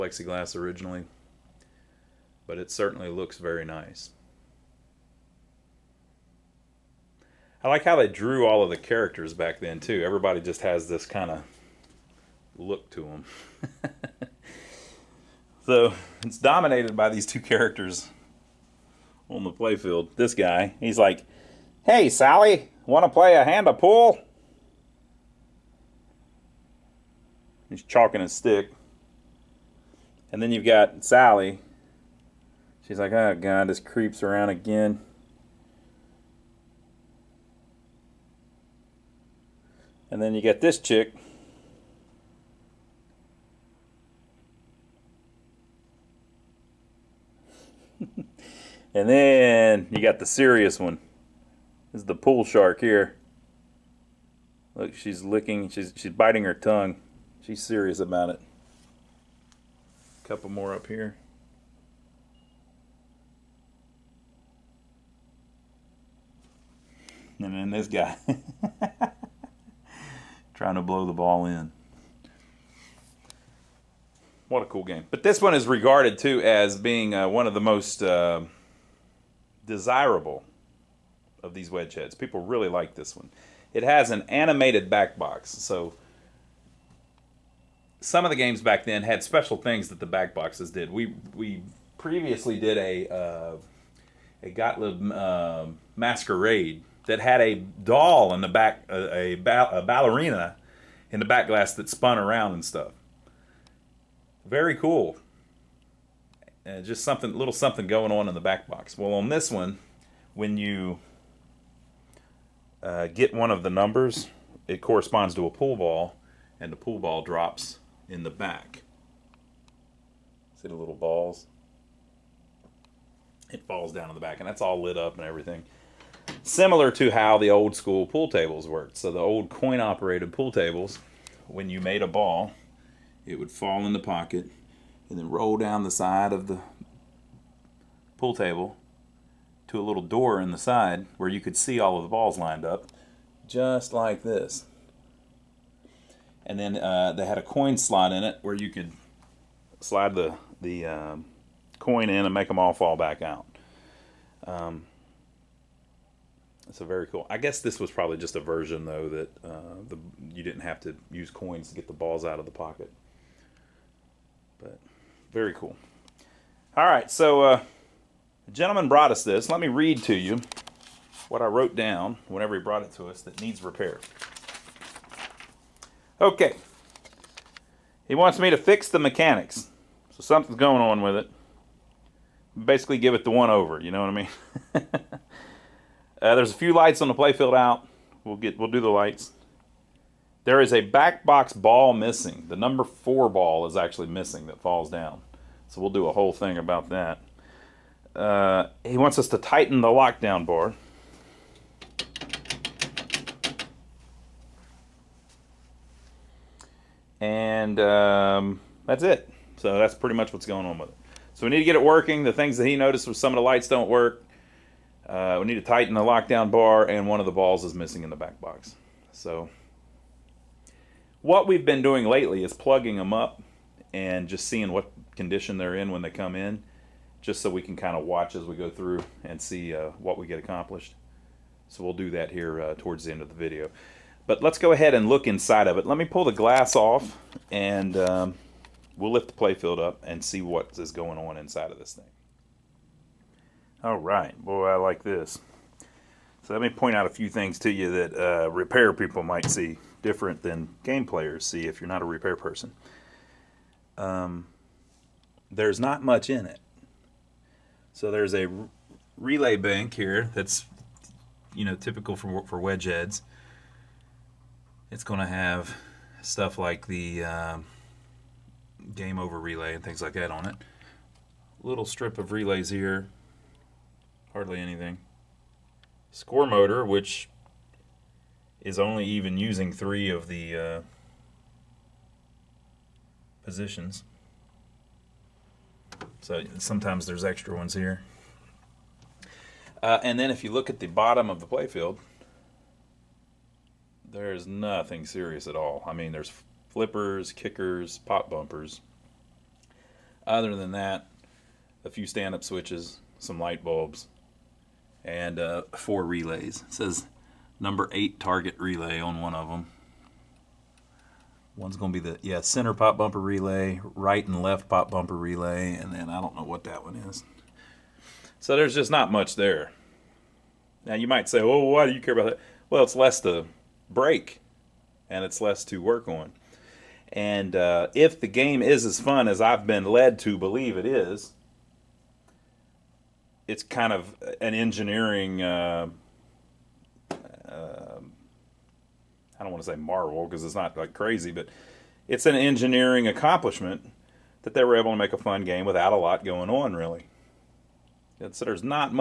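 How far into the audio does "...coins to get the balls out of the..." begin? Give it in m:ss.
2:41.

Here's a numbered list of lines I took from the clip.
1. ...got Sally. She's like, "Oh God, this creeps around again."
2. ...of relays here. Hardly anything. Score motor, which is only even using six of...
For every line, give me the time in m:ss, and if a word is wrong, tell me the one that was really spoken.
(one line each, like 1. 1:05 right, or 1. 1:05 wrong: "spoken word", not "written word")
1. 0:30 right
2. 4:32 wrong: "three", not "six".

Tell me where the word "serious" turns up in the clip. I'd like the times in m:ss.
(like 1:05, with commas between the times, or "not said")
0:50, 0:57, 4:55.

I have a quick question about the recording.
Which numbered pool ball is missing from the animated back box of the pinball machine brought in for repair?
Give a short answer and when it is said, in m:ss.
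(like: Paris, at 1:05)
4, at 3:12.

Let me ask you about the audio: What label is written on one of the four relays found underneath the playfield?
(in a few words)
Number eight target relay.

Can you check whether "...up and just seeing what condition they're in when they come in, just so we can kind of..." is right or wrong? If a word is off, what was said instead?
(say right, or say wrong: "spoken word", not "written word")
right.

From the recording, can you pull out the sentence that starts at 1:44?
Very cool and just something, little something going on in the back box.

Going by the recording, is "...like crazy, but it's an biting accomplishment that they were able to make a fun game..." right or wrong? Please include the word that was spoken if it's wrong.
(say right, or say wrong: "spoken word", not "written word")
wrong: "engineering", not "biting".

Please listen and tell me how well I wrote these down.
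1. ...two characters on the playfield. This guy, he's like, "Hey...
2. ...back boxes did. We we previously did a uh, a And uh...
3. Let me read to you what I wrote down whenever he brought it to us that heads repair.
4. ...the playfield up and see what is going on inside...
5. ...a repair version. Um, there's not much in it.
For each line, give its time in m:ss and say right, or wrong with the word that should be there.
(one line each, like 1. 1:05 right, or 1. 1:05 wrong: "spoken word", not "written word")
1. 0:17 right
2. 1:30 wrong: "Gottlieb", not "And"
3. 2:49 wrong: "needs", not "heads"
4. 3:59 right
5. 4:12 wrong: "person", not "version".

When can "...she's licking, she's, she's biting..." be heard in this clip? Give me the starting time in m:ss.
0:54.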